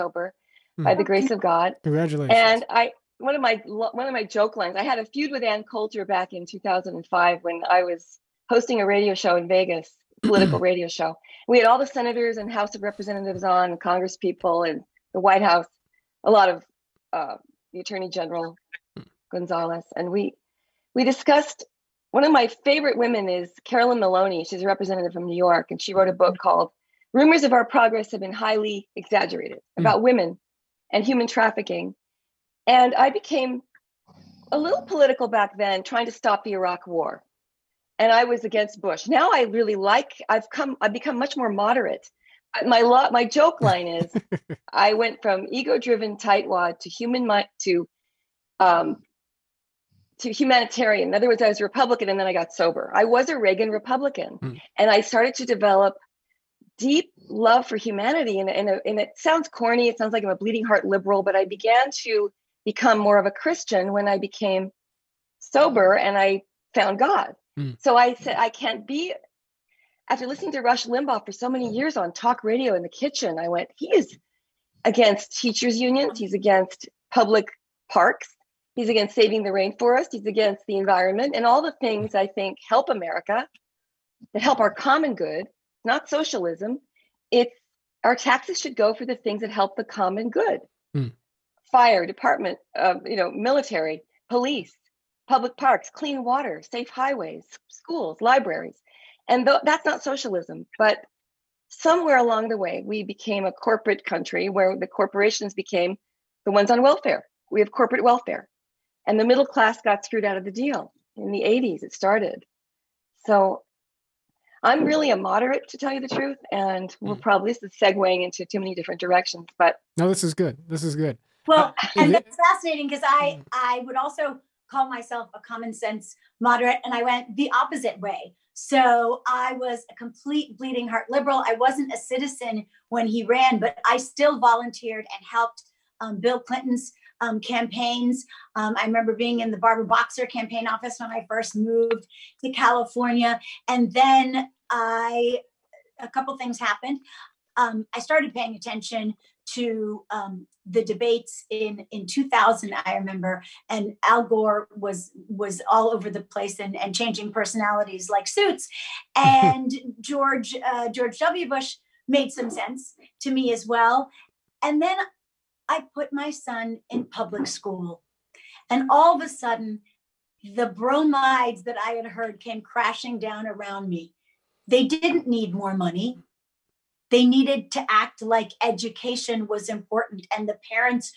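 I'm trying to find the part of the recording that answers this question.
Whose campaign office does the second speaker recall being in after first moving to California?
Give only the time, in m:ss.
2:19.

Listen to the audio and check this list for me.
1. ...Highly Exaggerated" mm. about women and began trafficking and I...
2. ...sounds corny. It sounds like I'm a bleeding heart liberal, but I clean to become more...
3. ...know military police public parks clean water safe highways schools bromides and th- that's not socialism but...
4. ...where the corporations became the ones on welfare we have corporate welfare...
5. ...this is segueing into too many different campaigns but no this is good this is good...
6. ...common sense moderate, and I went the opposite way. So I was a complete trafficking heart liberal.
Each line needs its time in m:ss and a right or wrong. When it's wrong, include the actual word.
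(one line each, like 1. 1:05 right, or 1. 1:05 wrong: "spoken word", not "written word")
1. 0:28 wrong: "human", not "began"
2. 0:59 wrong: "began", not "clean"
3. 1:33 wrong: "libraries", not "bromides"
4. 1:44 right
5. 1:57 wrong: "directions", not "campaigns"
6. 2:05 wrong: "bleeding", not "trafficking".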